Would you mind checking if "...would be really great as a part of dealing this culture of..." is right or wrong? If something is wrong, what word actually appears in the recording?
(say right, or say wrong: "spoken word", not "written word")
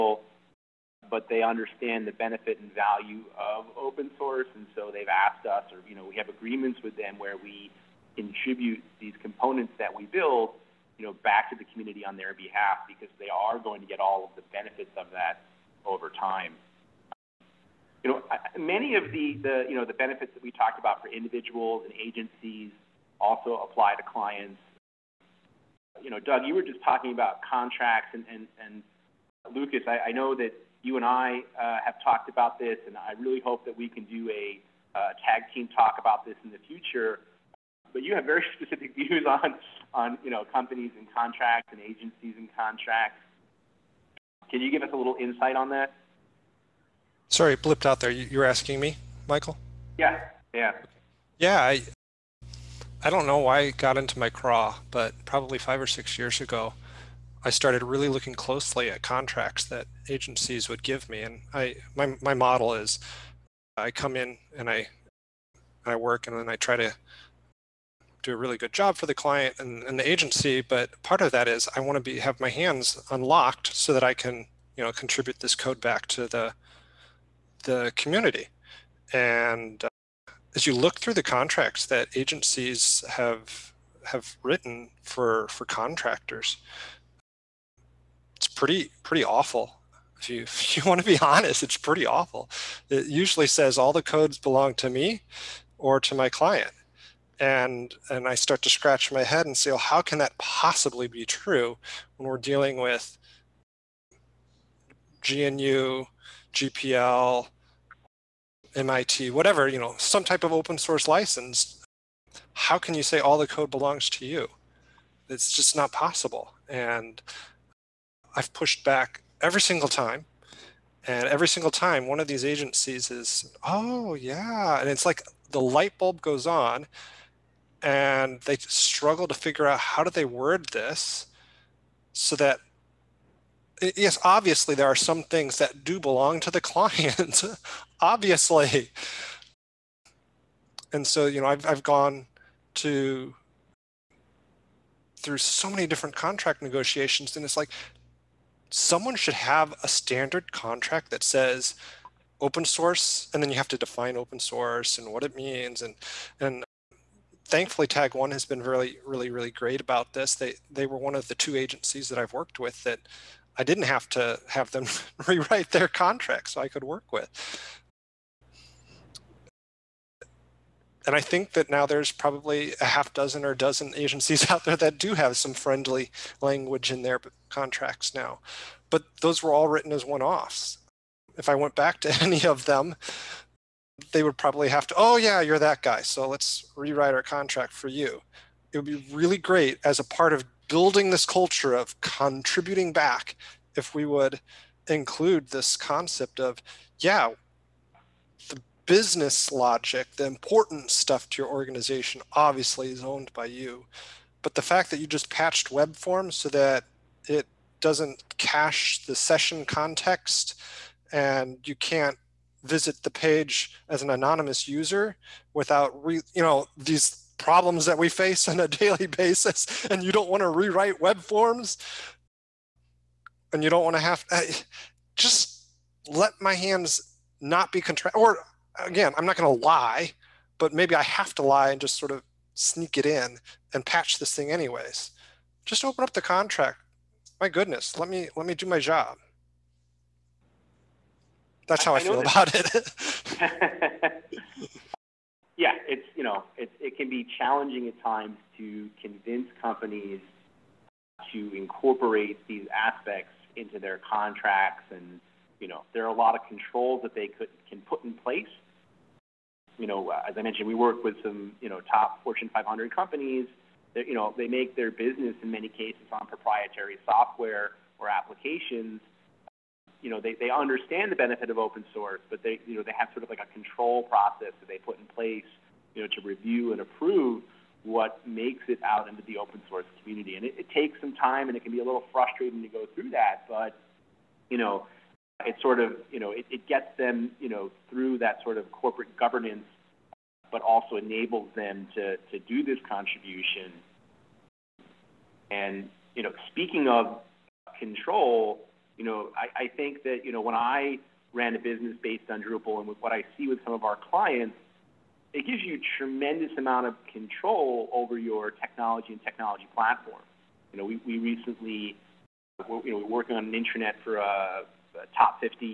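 wrong: "building", not "dealing".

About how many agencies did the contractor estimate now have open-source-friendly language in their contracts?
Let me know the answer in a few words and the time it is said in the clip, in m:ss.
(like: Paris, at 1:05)
half dozen or dozen, at 2:52.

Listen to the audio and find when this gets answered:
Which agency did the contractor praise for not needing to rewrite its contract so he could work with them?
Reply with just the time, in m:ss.
2:37.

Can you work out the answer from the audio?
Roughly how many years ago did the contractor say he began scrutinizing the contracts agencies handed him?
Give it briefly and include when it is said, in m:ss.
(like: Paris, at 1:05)
5 or 6 years, at 0:55.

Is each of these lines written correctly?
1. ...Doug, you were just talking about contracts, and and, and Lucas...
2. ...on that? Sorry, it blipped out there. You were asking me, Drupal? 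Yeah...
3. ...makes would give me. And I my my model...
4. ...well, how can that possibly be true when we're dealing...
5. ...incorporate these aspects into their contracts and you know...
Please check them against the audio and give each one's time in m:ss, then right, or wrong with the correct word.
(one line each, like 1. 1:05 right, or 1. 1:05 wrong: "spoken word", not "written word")
1. 0:26 right
2. 0:45 wrong: "Michael", not "Drupal"
3. 1:00 wrong: "agencies", not "makes"
4. 1:39 right
5. 4:11 right.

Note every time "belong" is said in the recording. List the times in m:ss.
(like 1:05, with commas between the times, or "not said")
1:34, 1:53, 2:15.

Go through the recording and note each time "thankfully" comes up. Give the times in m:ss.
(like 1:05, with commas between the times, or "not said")
2:37.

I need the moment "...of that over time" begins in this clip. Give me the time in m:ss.
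0:14.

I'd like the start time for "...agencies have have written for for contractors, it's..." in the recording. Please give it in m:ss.
1:22.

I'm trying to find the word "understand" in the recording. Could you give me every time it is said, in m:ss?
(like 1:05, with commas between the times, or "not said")
0:01, 4:30.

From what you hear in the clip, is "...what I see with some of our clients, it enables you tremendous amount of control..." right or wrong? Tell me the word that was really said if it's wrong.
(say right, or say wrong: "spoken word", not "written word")
wrong: "gives", not "enables".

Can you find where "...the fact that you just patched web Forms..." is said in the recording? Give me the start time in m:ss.
3:24.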